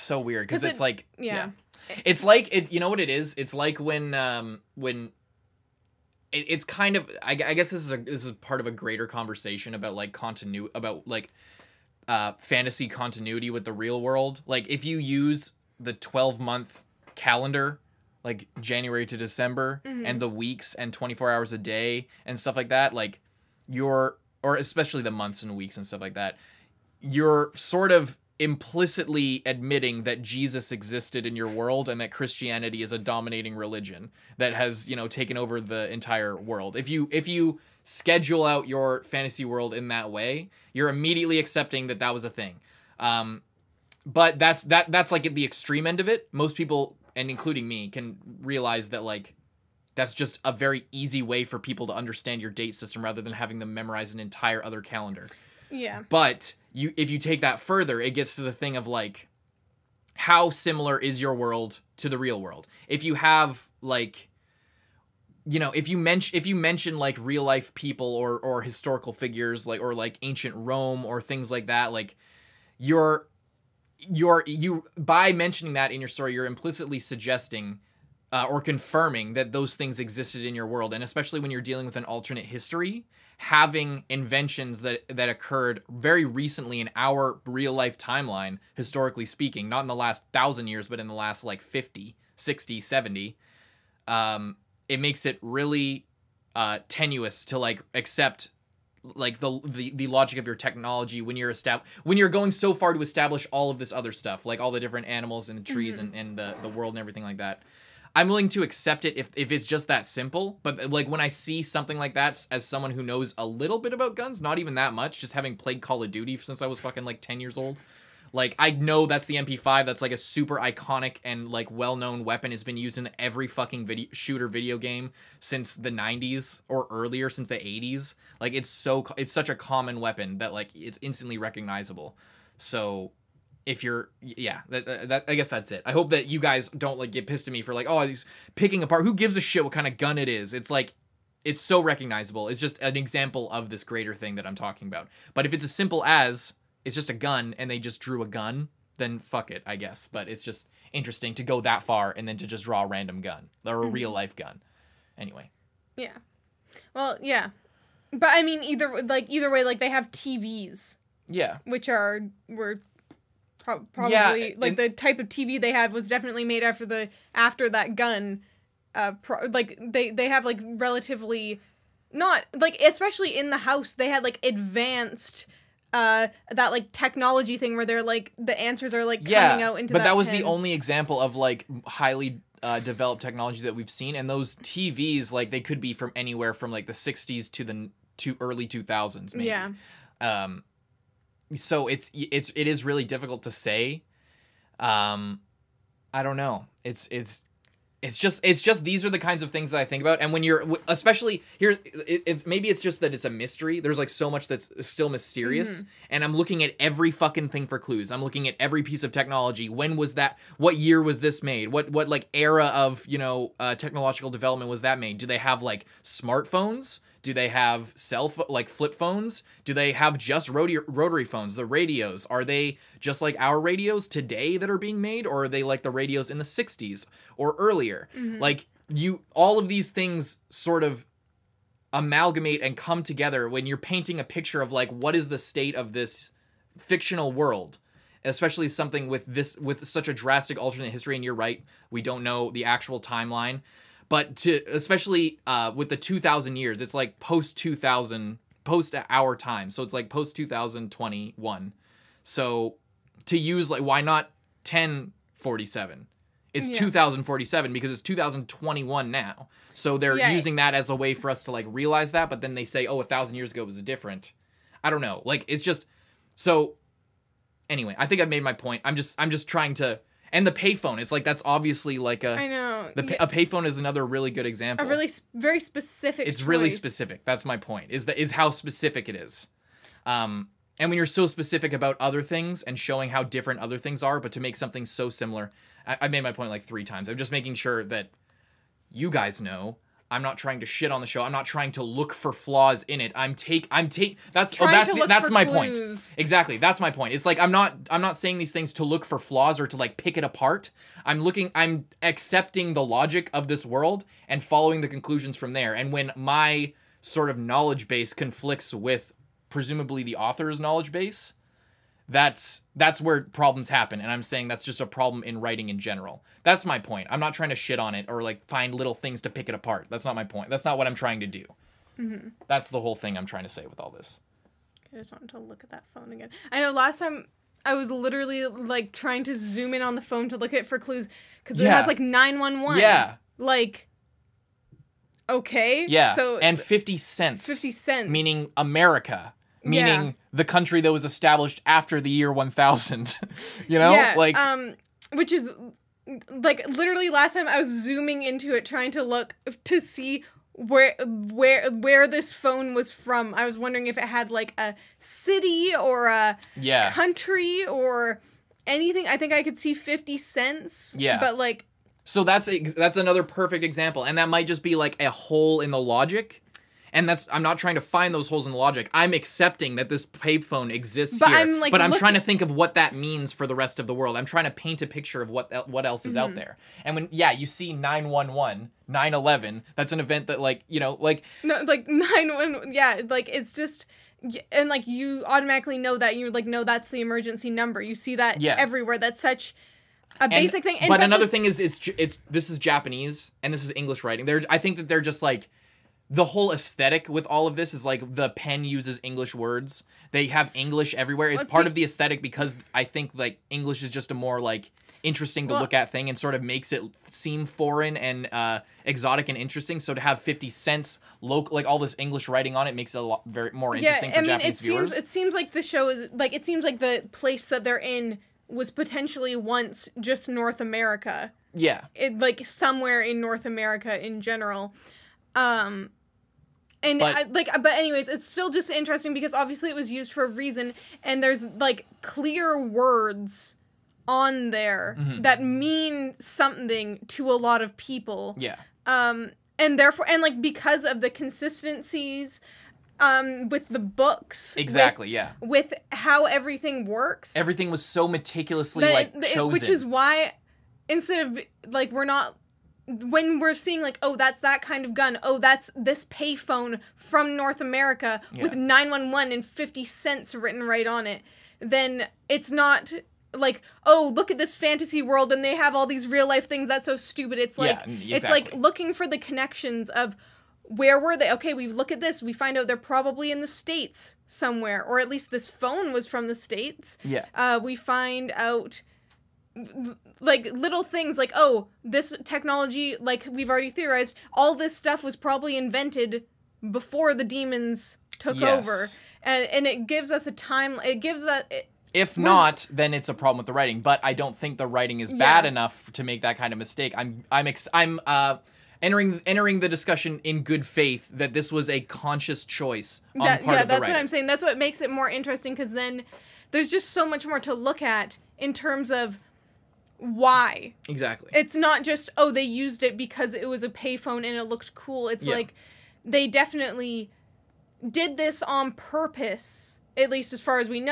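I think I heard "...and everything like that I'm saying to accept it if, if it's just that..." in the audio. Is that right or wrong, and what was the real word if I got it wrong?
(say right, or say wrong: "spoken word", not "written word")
wrong: "willing", not "saying".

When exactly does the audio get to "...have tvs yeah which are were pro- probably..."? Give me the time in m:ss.
2:39.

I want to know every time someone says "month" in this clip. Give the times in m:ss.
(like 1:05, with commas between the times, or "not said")
0:16, 0:25.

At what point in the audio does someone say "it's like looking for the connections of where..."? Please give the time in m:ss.
7:48.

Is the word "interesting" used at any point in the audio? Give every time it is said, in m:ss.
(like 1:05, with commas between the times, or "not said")
2:30, 6:45, 6:49, 6:53, 7:08, 8:25.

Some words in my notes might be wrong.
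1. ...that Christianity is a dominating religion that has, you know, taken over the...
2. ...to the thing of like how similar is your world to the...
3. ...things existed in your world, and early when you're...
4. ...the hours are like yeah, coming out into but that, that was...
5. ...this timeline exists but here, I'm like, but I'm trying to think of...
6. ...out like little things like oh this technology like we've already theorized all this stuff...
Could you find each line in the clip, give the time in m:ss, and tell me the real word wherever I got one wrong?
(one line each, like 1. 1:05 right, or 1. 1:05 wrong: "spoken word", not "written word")
1. 0:32 right
2. 0:58 right
3. 1:19 wrong: "especially", not "early"
4. 2:58 wrong: "answers", not "hours"
5. 6:09 wrong: "payphone", not "timeline"
6. 7:58 right.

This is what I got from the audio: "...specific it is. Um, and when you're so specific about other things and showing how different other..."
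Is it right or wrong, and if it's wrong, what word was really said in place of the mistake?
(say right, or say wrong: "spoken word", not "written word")
right.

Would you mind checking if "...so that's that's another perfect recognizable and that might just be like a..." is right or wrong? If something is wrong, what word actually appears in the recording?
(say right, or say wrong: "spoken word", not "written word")
wrong: "example", not "recognizable".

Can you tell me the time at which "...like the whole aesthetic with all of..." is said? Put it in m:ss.
6:35.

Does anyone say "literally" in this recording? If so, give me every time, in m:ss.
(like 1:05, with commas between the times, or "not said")
5:27, 5:46.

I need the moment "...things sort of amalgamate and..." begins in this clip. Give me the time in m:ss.
3:49.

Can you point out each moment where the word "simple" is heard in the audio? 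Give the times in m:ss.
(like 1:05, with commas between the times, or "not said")
1:50, 2:25.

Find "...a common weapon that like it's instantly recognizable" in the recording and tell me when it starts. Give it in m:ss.
2:09.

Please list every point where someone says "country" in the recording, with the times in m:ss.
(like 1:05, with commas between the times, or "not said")
5:40, 5:56.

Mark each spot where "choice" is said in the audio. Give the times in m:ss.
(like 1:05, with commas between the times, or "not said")
4:36, 8:22.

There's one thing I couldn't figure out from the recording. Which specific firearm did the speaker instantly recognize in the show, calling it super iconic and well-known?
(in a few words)
MP5.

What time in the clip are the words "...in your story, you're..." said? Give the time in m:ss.
1:15.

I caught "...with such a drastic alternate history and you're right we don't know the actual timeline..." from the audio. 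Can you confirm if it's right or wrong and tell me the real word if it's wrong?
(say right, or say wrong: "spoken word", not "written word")
right.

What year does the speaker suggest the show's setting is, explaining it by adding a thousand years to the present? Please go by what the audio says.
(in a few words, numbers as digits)
2047.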